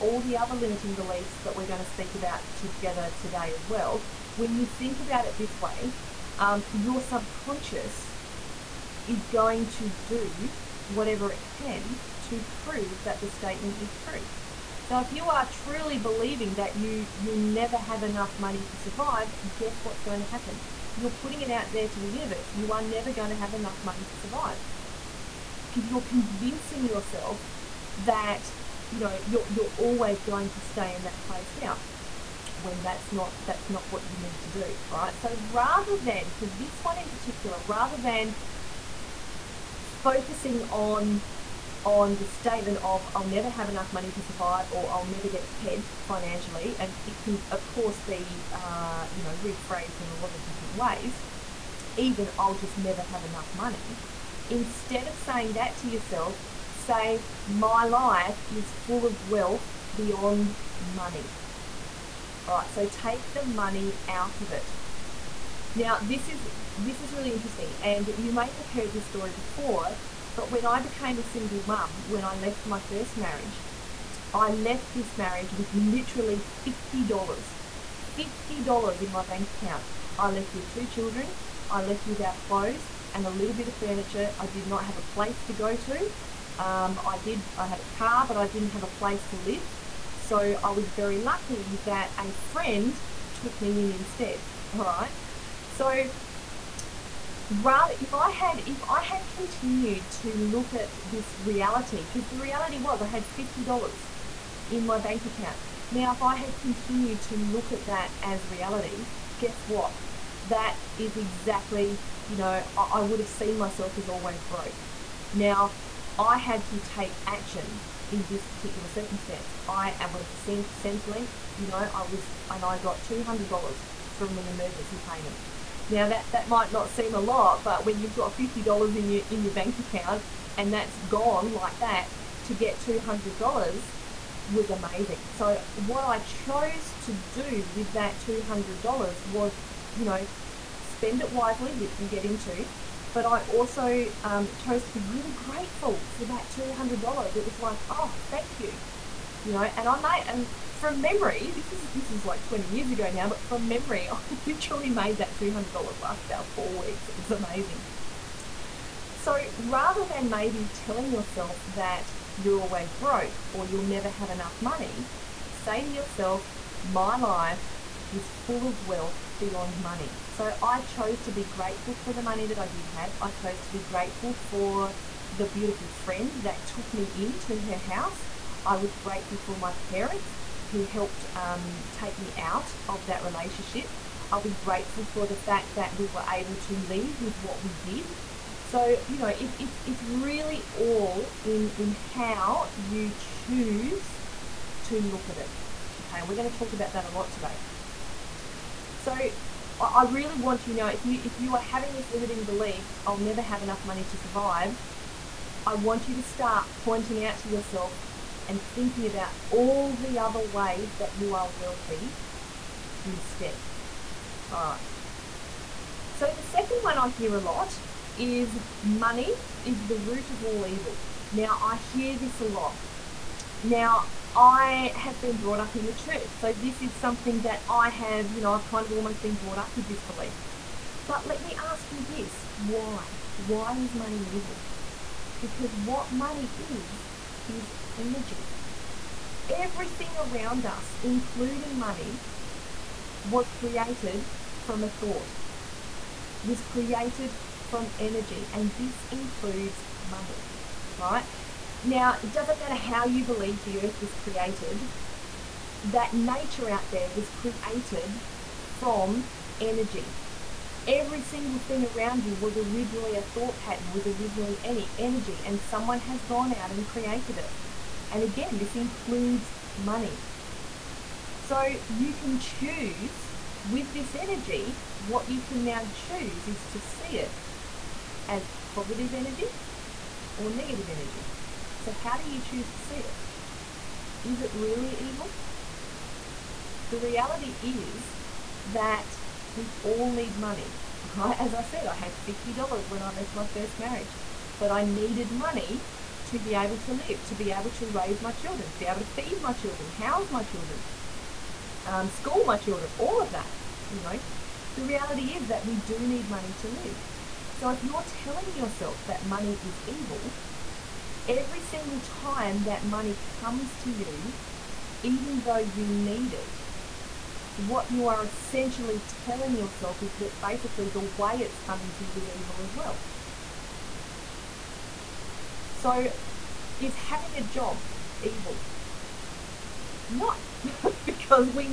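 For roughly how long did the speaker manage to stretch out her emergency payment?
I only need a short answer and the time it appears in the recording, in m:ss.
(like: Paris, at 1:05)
4 weeks, at 2:36.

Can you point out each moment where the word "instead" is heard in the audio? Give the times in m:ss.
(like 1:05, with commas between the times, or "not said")
0:54, 1:33, 3:33.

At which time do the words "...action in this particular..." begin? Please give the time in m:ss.
1:57.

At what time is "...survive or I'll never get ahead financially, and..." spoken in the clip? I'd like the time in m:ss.
0:44.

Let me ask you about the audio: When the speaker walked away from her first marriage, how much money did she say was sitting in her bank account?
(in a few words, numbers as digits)
$50.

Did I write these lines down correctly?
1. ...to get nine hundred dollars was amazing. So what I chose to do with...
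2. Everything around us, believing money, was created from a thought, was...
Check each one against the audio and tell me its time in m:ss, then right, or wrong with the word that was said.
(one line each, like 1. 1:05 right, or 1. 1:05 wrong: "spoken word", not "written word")
1. 2:12 wrong: "two", not "nine"
2. 3:59 wrong: "including", not "believing".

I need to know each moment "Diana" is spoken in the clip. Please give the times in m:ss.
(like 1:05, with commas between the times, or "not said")
not said.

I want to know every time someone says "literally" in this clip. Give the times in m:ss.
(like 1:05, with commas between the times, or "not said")
1:15, 2:34.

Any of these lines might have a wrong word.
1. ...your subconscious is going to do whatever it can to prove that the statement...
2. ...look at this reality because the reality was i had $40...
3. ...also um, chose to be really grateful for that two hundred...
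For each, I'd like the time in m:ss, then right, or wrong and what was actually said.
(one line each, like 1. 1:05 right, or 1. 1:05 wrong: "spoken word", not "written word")
1. 0:06 right
2. 1:40 wrong: "50", not "40"
3. 2:23 right.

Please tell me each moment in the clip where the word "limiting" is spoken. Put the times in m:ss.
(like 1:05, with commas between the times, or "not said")
0:00, 3:22.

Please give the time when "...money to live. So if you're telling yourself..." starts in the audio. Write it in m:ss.
5:06.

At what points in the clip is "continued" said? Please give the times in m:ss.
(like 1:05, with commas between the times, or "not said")
1:39, 1:46.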